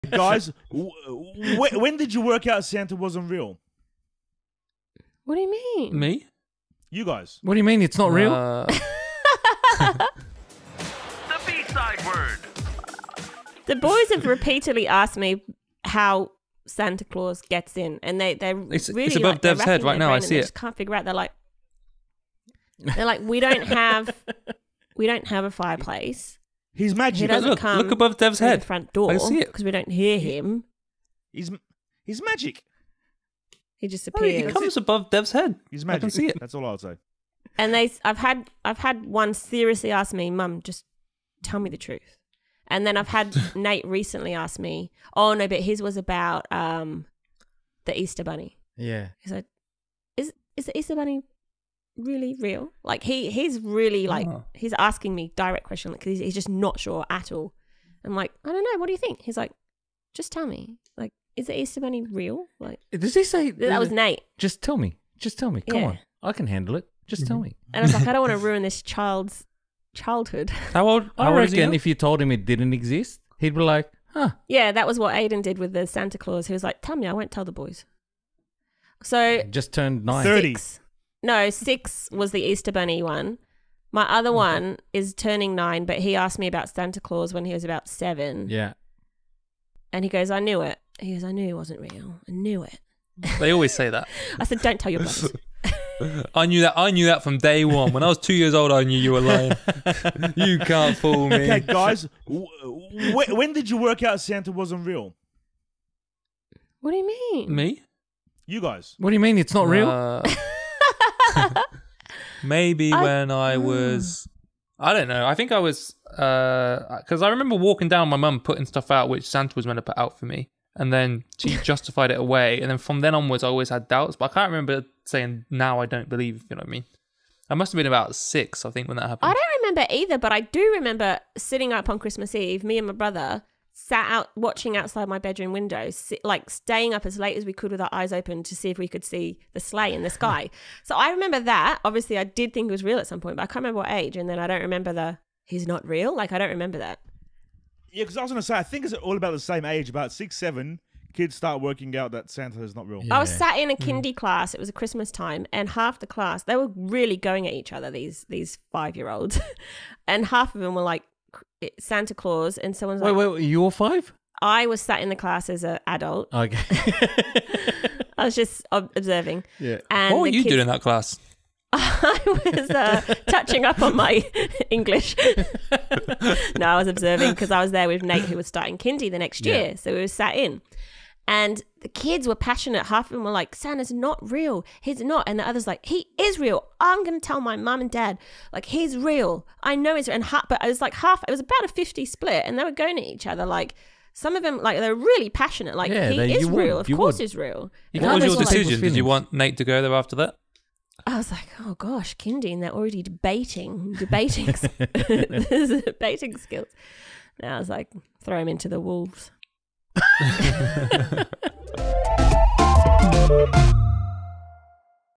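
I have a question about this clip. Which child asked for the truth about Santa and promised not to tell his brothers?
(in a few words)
Aiden.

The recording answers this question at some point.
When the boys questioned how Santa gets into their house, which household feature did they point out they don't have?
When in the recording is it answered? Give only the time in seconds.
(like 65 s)
25 s.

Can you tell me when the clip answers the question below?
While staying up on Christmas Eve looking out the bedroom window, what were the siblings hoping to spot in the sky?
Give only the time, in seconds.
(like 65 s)
139 s.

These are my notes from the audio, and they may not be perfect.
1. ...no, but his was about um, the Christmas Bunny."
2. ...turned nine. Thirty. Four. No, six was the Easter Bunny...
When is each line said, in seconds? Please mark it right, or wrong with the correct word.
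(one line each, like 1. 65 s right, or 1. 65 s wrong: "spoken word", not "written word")
1. 45 s wrong: "Easter", not "Christmas"
2. 79 s wrong: "Six", not "Four".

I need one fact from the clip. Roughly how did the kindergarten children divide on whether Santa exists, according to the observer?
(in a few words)
50/50 split.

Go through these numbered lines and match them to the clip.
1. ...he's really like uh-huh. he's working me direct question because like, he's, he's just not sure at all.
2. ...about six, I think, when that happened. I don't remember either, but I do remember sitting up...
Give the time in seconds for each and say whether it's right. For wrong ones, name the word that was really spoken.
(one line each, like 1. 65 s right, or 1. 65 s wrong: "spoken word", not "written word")
1. 53 s wrong: "asking", not "working"
2. 127 s right.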